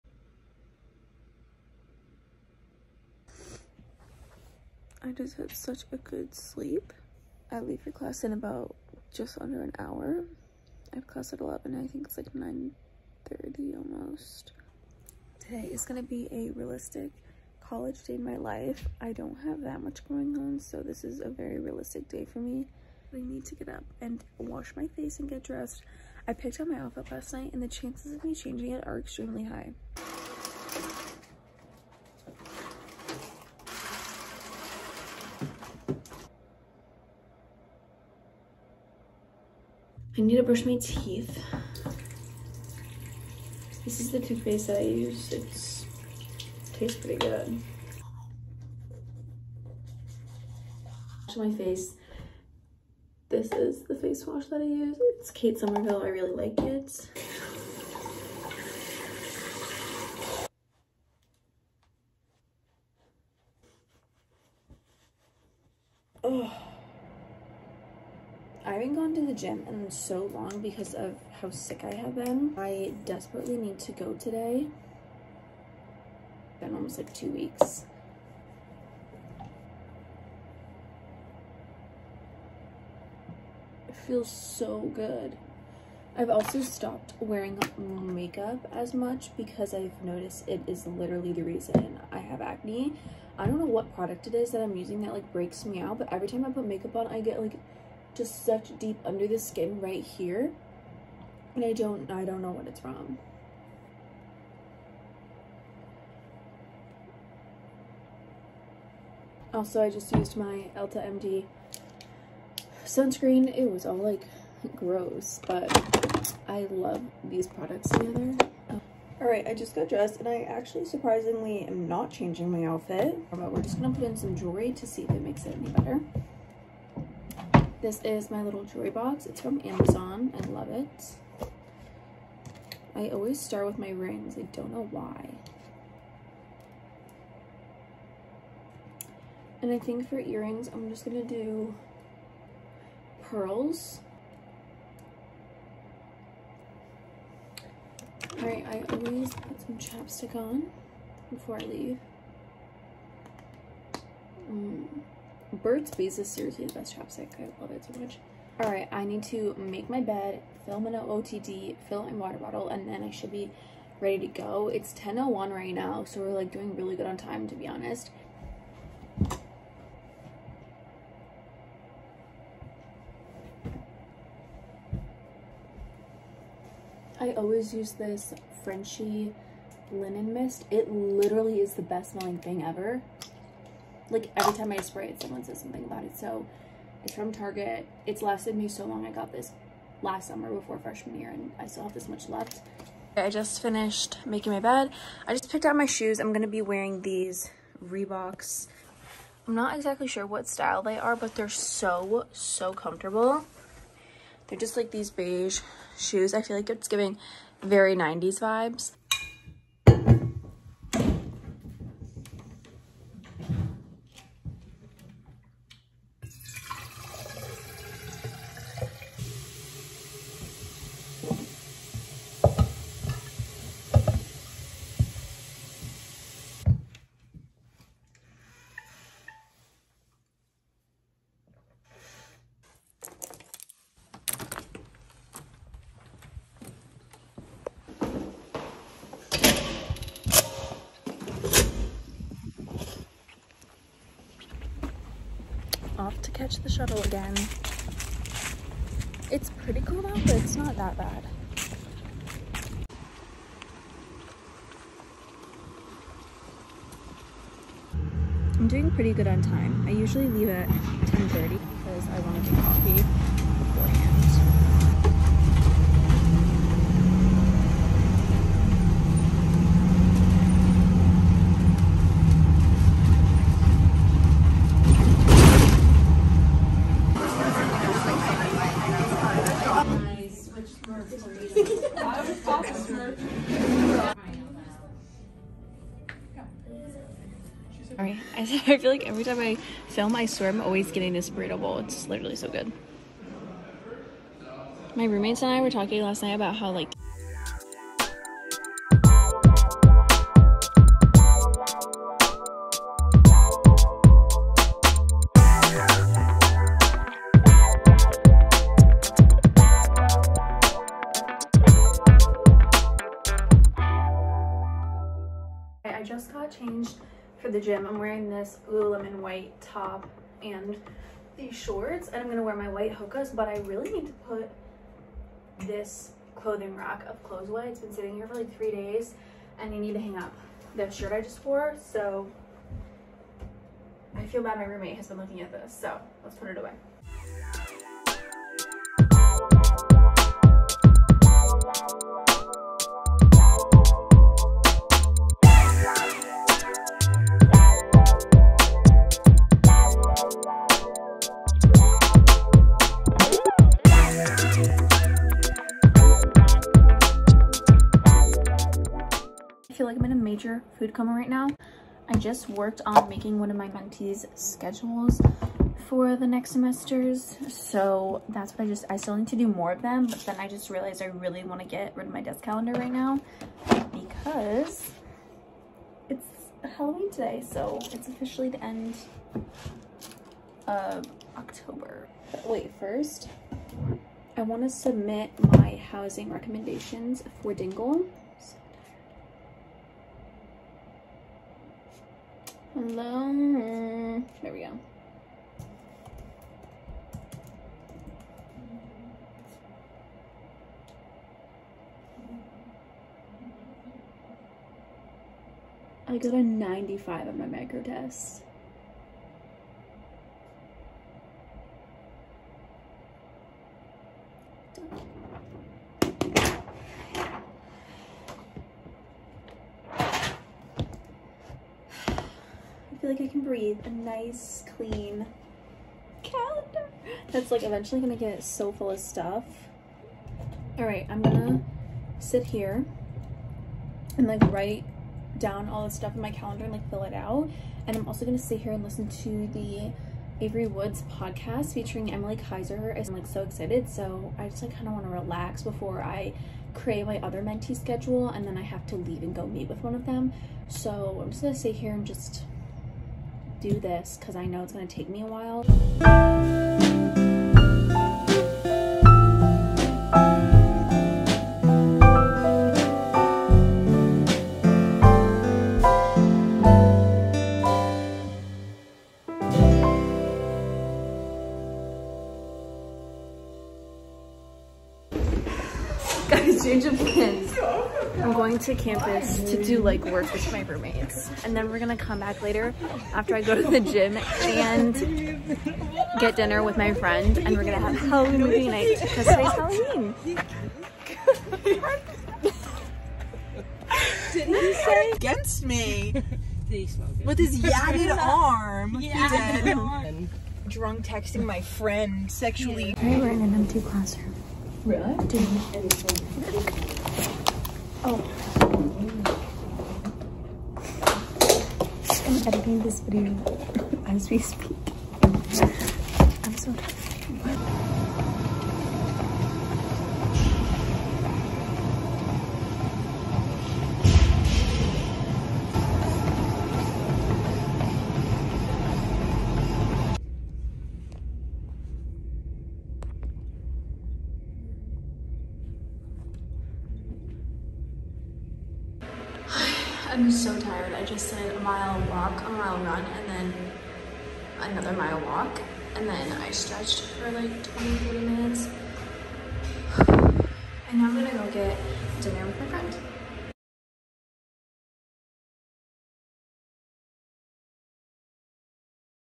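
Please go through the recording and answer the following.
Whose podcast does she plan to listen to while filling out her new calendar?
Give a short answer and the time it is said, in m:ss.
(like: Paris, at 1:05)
Avery Woods, at 7:20.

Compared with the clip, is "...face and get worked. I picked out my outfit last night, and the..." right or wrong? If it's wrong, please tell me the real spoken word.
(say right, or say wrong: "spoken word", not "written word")
wrong: "dressed", not "worked".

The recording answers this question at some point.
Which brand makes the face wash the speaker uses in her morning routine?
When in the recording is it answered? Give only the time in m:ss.
0:55.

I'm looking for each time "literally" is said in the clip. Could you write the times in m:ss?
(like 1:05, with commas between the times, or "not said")
1:30, 3:00, 4:52.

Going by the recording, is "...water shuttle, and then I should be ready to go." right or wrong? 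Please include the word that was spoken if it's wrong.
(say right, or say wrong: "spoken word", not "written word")
wrong: "bottle", not "shuttle".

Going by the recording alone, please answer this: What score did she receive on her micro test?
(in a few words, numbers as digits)
95.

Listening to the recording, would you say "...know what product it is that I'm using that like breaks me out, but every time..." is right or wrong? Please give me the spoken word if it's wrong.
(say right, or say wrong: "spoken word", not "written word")
right.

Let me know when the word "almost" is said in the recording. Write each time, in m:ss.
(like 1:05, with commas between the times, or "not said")
0:13, 1:16.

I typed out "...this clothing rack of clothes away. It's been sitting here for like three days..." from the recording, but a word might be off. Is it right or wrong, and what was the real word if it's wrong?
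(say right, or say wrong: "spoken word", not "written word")
right.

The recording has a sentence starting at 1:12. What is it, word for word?
I desperately need to go today.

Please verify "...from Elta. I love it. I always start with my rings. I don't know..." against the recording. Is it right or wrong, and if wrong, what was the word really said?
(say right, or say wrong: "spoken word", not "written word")
wrong: "Amazon", not "Elta".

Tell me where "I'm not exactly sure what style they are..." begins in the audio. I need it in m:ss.
3:19.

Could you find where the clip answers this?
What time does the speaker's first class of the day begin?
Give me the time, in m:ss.
0:11.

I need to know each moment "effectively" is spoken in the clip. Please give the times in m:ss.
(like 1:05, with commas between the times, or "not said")
not said.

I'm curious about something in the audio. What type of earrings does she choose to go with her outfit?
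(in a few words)
pearls.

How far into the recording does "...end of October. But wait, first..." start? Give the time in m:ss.
6:18.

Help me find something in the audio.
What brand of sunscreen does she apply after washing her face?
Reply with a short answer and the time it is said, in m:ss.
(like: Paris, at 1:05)
Elta MD, at 1:50.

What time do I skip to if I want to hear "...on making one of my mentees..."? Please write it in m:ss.
6:02.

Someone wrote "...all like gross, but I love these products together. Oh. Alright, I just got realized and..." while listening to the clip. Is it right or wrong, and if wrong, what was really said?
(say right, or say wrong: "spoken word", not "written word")
wrong: "dressed", not "realized".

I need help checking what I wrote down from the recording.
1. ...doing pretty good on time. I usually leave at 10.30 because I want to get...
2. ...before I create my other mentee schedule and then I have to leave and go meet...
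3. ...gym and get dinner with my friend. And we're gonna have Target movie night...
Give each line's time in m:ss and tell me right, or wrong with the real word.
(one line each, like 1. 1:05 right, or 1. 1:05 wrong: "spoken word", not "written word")
1. 4:18 right
2. 7:25 right
3. 8:03 wrong: "Halloween", not "Target".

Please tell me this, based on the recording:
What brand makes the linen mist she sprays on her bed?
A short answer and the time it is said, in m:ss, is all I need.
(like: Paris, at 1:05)
Frenchy, at 2:58.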